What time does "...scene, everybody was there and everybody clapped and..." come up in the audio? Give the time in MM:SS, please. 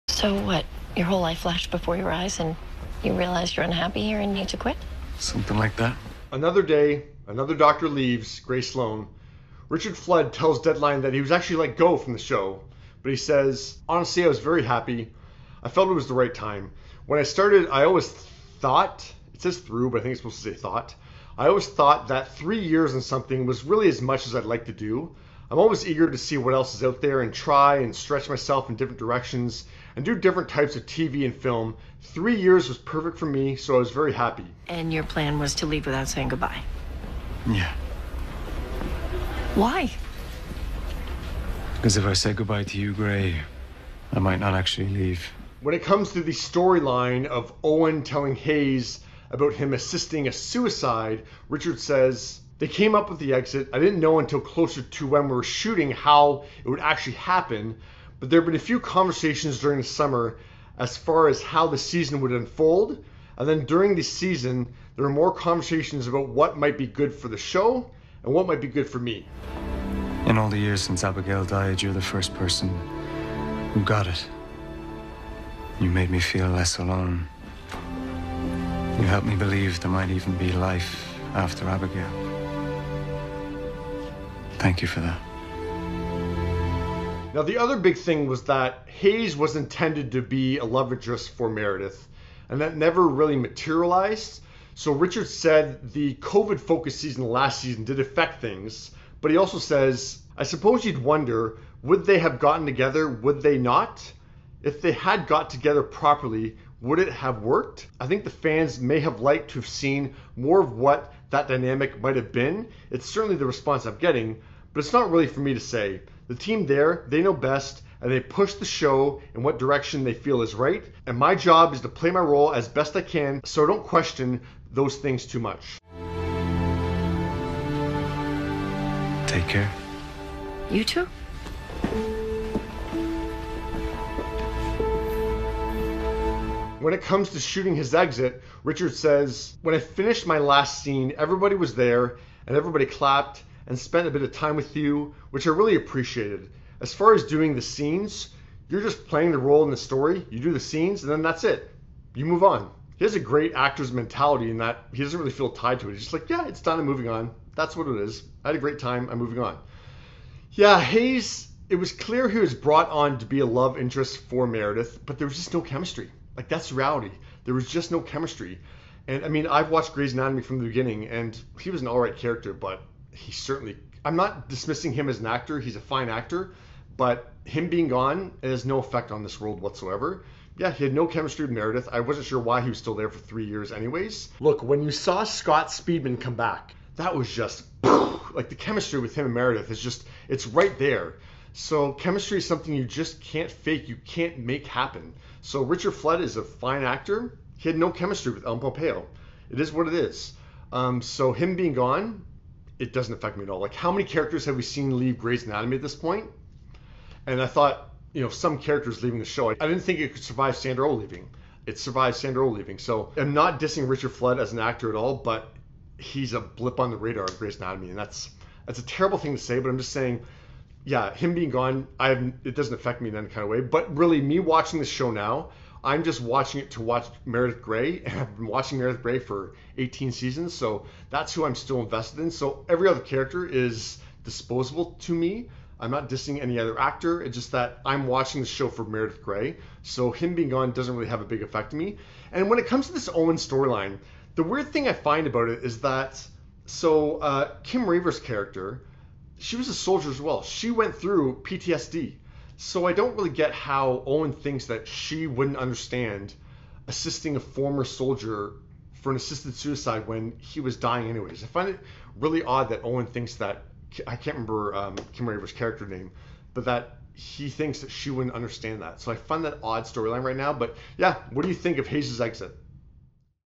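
02:20.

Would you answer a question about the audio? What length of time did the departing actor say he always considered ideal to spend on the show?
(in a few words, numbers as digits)
three years and something.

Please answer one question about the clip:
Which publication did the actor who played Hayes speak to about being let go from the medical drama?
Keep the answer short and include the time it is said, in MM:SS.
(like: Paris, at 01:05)
Deadline, at 00:10.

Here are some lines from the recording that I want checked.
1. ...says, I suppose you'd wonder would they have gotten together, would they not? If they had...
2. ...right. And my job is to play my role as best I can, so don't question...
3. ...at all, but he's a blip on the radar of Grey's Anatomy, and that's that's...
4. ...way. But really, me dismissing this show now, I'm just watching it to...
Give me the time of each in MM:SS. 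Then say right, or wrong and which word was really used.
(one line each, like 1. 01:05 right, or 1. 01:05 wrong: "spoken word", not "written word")
1. 01:39 right
2. 02:00 right
3. 03:34 right
4. 03:43 wrong: "watching", not "dismissing".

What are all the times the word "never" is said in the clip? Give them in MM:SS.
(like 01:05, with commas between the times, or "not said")
01:32.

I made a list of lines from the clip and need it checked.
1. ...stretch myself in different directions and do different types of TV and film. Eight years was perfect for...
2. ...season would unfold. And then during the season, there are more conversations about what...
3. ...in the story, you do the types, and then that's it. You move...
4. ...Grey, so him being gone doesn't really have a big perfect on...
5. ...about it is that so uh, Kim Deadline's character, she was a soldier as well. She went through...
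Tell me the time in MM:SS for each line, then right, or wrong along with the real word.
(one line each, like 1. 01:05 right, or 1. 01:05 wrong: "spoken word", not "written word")
1. 00:27 wrong: "Three", not "Eight"
2. 01:01 right
3. 02:29 wrong: "scenes", not "types"
4. 03:59 wrong: "effect", not "perfect"
5. 04:05 wrong: "Raver", not "Deadline".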